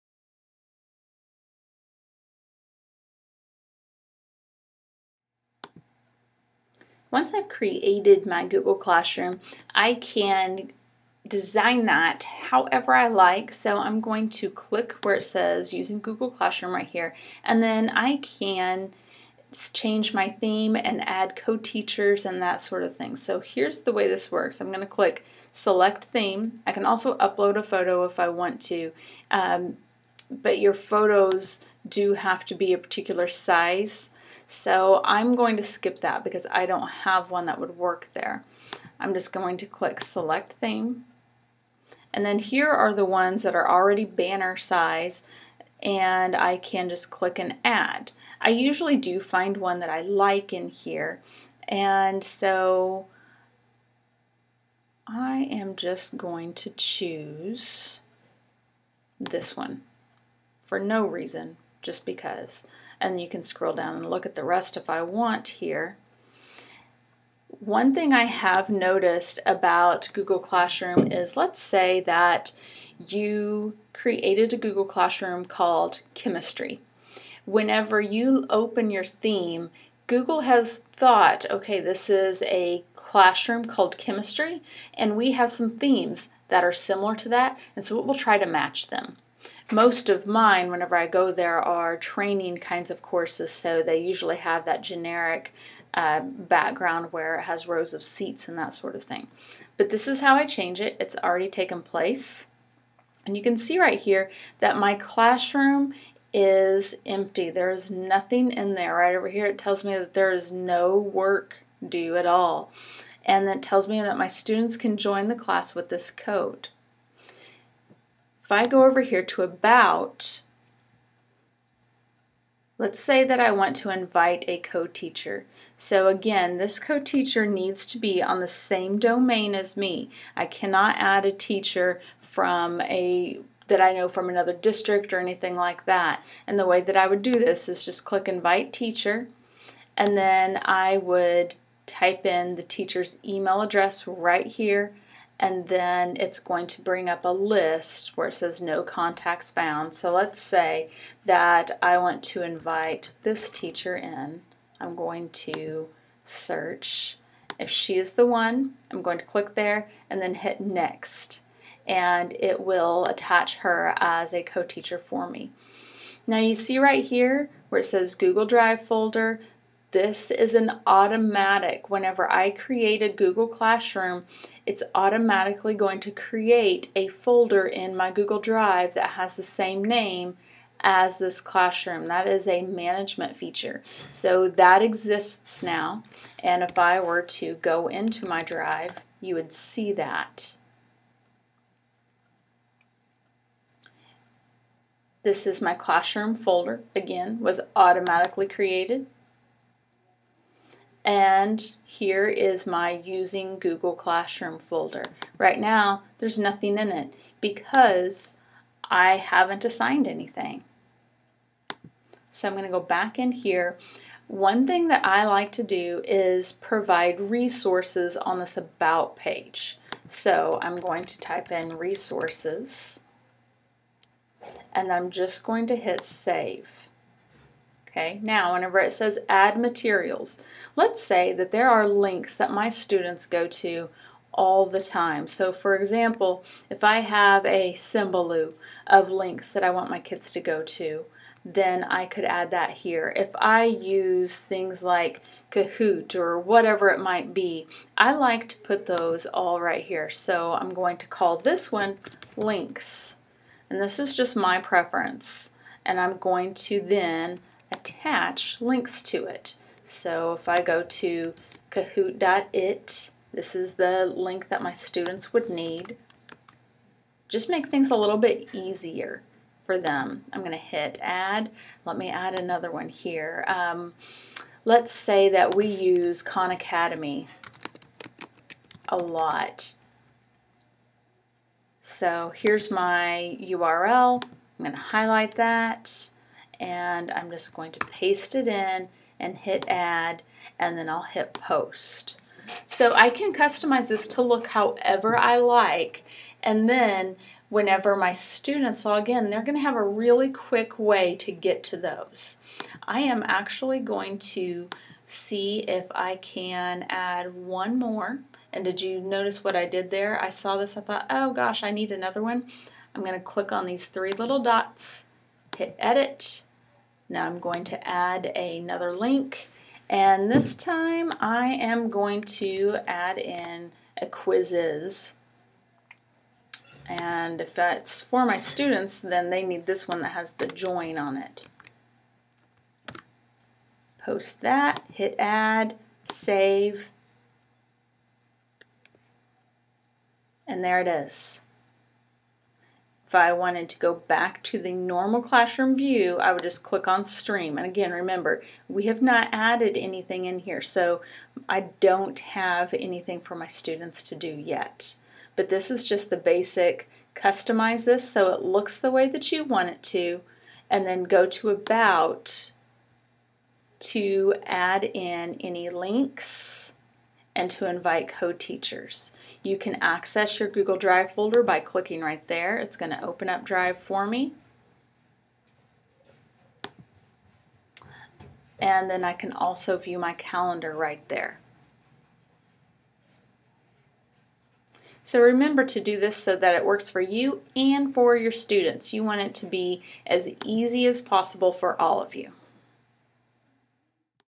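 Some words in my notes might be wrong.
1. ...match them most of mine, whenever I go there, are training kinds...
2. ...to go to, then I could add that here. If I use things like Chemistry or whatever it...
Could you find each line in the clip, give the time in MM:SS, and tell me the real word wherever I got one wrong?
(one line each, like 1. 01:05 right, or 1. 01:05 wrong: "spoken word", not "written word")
1. 01:28 right
2. 04:00 wrong: "Kahoot", not "Chemistry".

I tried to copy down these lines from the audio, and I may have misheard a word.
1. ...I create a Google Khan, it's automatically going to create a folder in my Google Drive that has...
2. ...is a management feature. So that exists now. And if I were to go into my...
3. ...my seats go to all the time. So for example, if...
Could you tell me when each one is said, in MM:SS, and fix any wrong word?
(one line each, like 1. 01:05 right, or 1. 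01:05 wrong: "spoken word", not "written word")
1. 02:52 wrong: "Classroom", not "Khan"
2. 03:02 right
3. 03:52 wrong: "students", not "seats".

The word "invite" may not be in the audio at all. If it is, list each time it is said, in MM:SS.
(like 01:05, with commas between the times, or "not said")
02:03, 02:18, 02:32, 06:07.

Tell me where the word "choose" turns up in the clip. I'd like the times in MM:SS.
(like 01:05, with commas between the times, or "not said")
00:56.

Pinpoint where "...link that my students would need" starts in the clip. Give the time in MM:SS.
04:24.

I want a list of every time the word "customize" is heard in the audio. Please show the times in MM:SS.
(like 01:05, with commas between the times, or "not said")
04:53, 05:57.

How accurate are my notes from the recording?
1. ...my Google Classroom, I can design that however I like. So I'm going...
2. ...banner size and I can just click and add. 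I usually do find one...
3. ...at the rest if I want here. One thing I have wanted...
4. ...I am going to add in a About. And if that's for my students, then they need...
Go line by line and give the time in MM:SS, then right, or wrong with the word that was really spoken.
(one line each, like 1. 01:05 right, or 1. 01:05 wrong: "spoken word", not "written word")
1. 00:08 right
2. 00:44 right
3. 01:04 wrong: "noticed", not "wanted"
4. 05:21 wrong: "Quizizz", not "About".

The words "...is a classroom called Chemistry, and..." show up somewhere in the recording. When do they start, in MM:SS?
01:22.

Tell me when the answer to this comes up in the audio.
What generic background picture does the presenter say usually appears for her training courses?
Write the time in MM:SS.
01:37.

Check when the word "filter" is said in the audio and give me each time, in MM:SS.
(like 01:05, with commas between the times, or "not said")
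not said.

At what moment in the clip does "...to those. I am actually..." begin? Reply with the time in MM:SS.
05:01.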